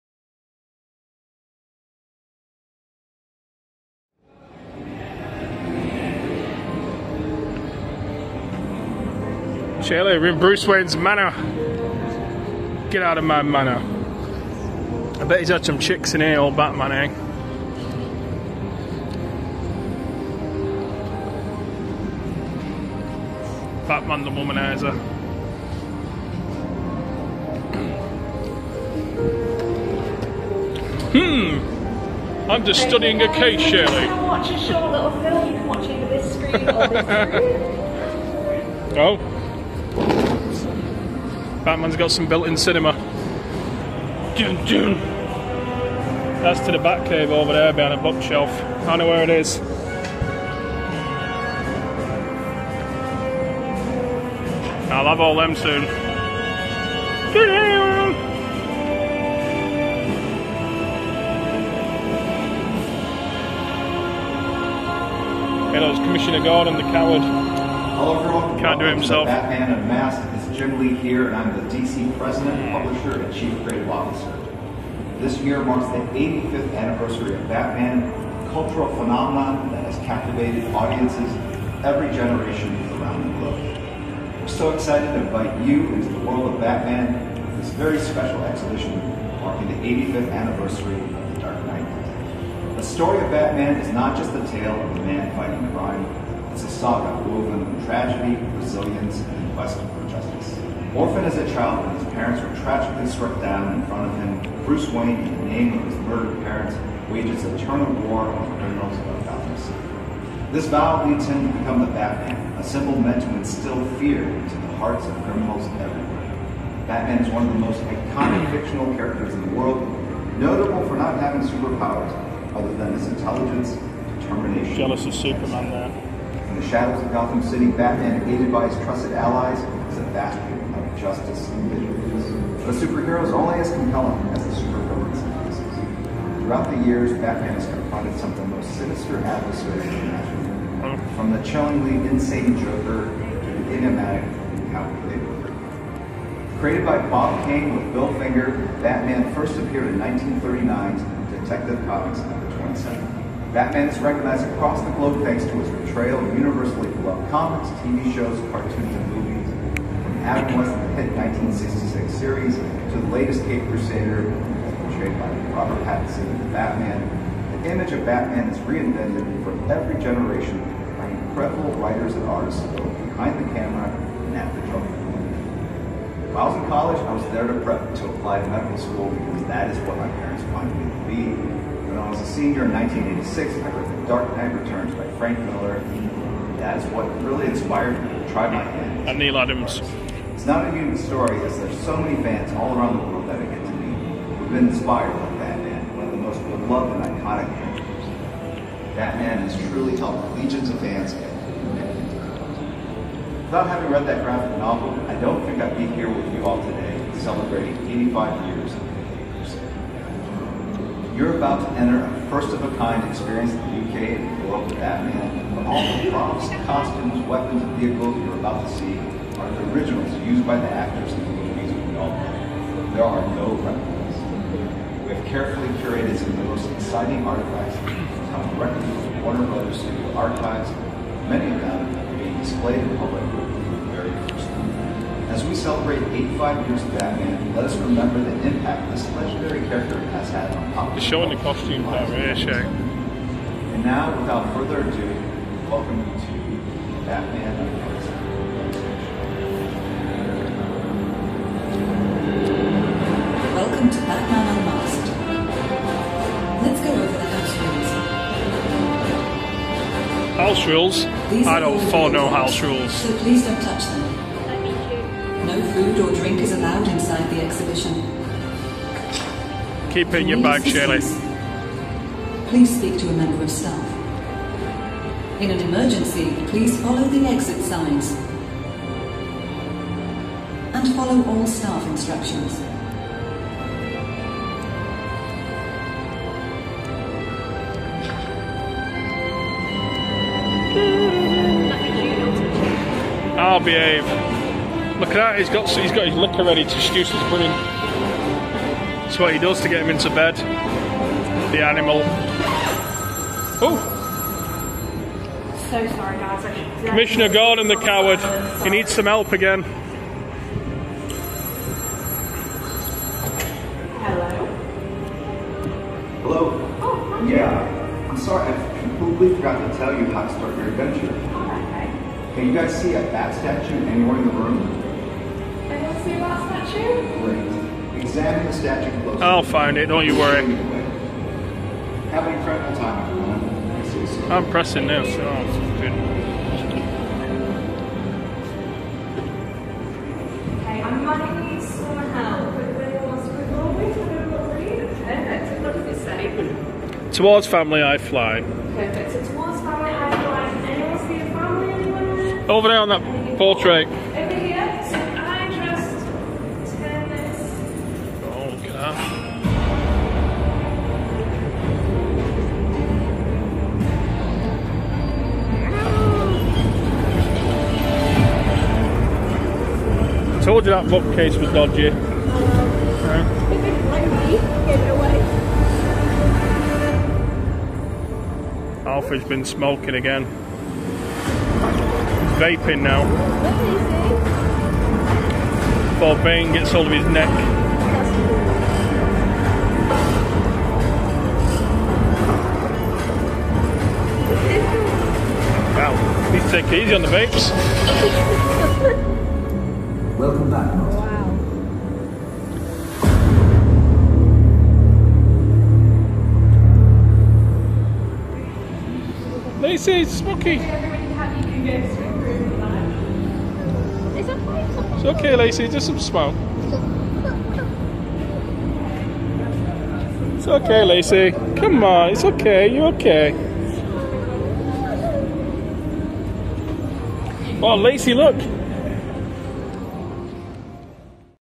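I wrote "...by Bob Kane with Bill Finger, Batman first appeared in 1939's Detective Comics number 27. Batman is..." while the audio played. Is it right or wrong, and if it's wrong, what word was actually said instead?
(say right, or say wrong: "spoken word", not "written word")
right.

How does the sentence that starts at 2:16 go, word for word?
Throughout the years, Batman has confronted some of the most sinister adversaries imaginable.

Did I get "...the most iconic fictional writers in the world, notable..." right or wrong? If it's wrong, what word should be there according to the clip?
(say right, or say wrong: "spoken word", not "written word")
wrong: "characters", not "writers".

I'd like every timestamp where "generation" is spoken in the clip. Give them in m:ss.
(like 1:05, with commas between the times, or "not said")
1:22, 2:50.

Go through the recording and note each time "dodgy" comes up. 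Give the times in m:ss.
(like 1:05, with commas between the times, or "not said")
6:11.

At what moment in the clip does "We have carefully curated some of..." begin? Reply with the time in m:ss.
3:45.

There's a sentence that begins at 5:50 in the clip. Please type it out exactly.
Anyone see a family Over there on that portrait.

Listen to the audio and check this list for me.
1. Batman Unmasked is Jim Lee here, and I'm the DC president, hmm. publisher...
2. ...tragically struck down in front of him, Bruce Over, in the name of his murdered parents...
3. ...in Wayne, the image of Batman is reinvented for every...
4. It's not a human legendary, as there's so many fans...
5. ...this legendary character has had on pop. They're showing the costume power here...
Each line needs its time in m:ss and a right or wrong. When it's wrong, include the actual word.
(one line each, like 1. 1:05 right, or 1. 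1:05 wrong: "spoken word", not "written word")
1. 1:09 right
2. 1:42 wrong: "Wayne", not "Over"
3. 2:46 wrong: "Batman", not "Wayne"
4. 3:10 wrong: "story", not "legendary"
5. 3:58 right.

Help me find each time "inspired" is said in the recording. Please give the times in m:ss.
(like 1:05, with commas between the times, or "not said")
3:07, 3:14.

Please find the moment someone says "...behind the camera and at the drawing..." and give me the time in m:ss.
2:53.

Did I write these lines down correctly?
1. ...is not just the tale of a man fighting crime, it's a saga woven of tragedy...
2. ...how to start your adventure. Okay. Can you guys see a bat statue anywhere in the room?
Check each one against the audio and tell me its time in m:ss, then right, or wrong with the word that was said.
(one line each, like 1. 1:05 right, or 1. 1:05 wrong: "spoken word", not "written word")
1. 1:33 right
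2. 5:20 right.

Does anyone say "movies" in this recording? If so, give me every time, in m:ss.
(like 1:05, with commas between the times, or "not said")
2:39, 3:41.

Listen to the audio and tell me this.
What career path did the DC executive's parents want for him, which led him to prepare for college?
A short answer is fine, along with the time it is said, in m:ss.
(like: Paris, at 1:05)
medical school, at 2:58.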